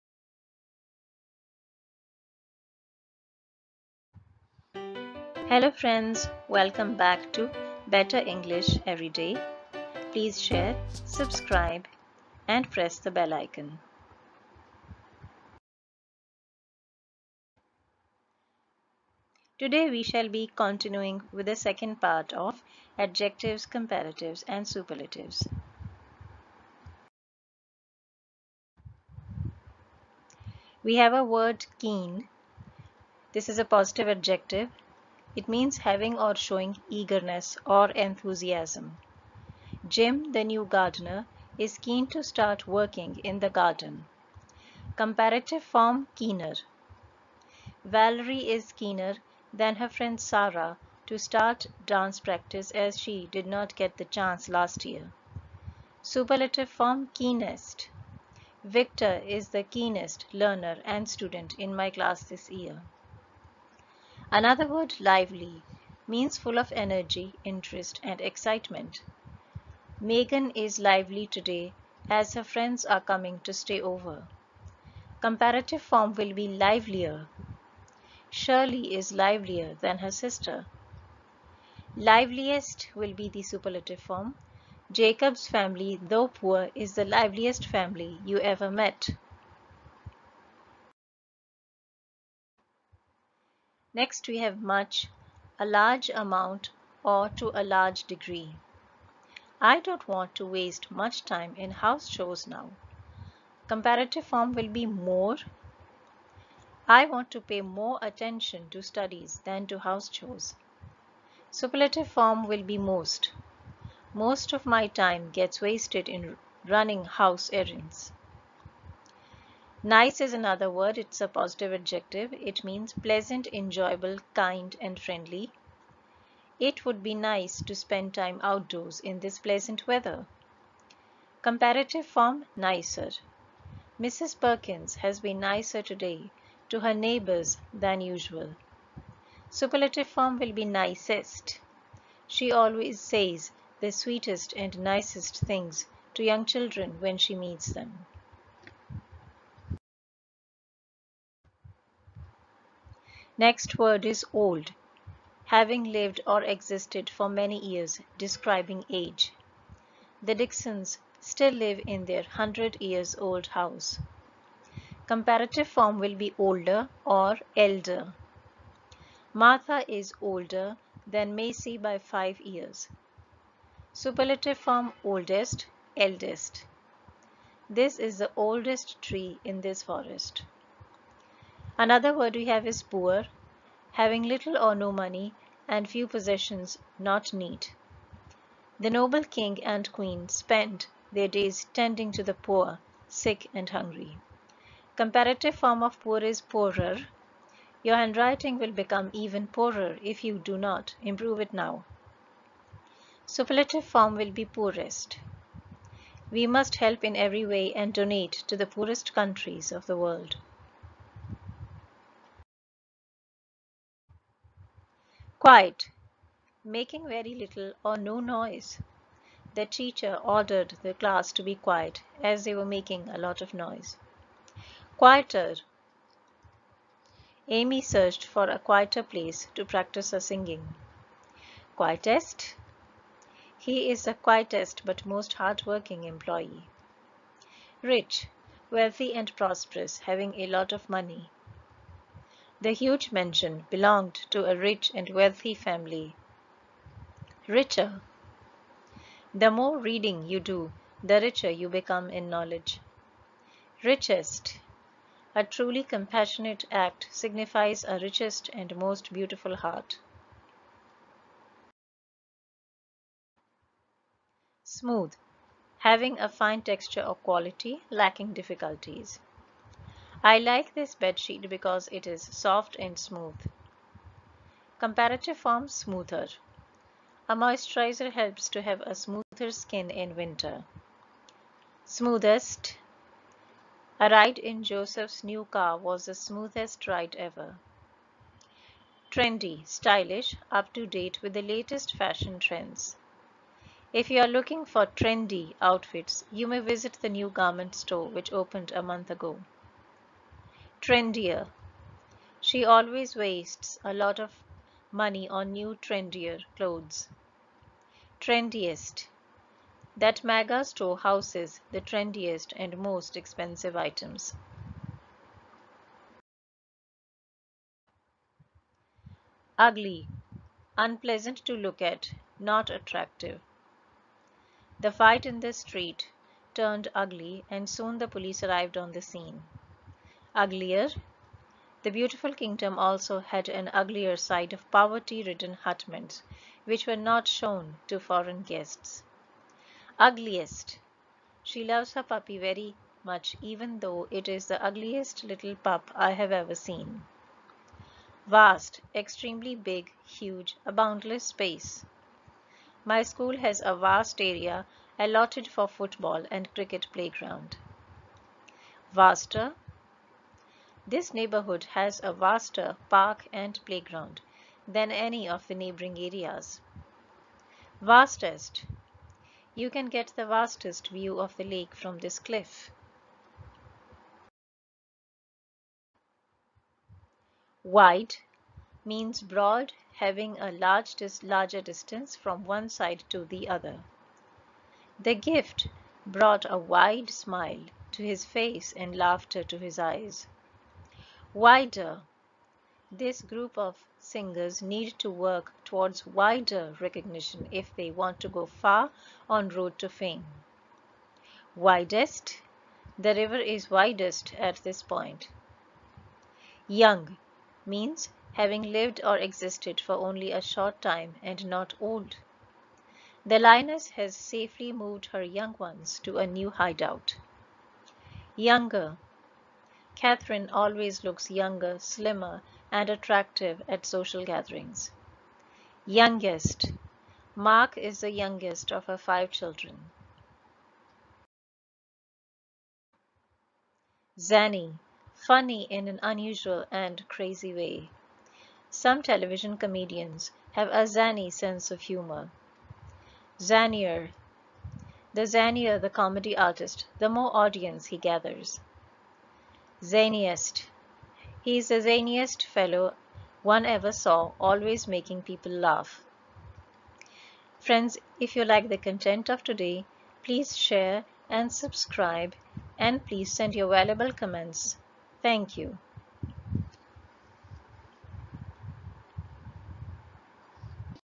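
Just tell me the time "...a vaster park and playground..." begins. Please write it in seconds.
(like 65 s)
362 s.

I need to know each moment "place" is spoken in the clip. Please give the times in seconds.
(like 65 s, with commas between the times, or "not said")
229 s.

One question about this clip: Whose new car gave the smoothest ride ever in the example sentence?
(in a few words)
Joseph.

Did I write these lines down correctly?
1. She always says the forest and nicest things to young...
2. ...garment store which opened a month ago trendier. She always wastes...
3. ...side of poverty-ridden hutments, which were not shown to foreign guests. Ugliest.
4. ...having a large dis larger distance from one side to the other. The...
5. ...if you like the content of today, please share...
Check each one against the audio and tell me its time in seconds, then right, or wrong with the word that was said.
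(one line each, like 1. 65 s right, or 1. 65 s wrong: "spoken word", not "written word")
1. 142 s wrong: "sweetest", not "forest"
2. 297 s right
3. 334 s right
4. 379 s right
5. 458 s right.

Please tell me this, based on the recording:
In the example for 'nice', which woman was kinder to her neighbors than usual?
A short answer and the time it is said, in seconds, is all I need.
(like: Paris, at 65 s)
Mrs. Perkins, at 133 s.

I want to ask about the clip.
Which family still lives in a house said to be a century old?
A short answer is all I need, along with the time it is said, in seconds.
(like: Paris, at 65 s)
The Dixons, at 160 s.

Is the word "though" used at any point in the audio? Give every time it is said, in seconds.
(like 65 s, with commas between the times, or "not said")
86 s, 343 s.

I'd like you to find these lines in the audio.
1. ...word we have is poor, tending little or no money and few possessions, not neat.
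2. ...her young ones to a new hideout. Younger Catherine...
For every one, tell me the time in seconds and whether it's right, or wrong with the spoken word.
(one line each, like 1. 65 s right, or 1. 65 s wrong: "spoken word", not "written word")
1. 182 s wrong: "having", not "tending"
2. 415 s right.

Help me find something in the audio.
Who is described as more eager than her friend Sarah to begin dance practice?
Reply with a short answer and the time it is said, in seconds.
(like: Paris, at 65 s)
Valerie, at 47 s.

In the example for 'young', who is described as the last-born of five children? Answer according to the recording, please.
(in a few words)
Mark.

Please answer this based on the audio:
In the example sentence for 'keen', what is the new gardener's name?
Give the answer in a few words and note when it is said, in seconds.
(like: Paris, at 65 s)
Jim, at 39 s.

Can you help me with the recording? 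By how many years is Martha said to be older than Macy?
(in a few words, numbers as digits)
5.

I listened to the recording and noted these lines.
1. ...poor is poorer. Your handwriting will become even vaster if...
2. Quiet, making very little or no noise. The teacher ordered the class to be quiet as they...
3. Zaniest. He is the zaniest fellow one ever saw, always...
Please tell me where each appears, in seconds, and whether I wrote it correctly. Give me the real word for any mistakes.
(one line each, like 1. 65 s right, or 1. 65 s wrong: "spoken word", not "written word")
1. 195 s wrong: "poorer", not "vaster"
2. 215 s right
3. 449 s right.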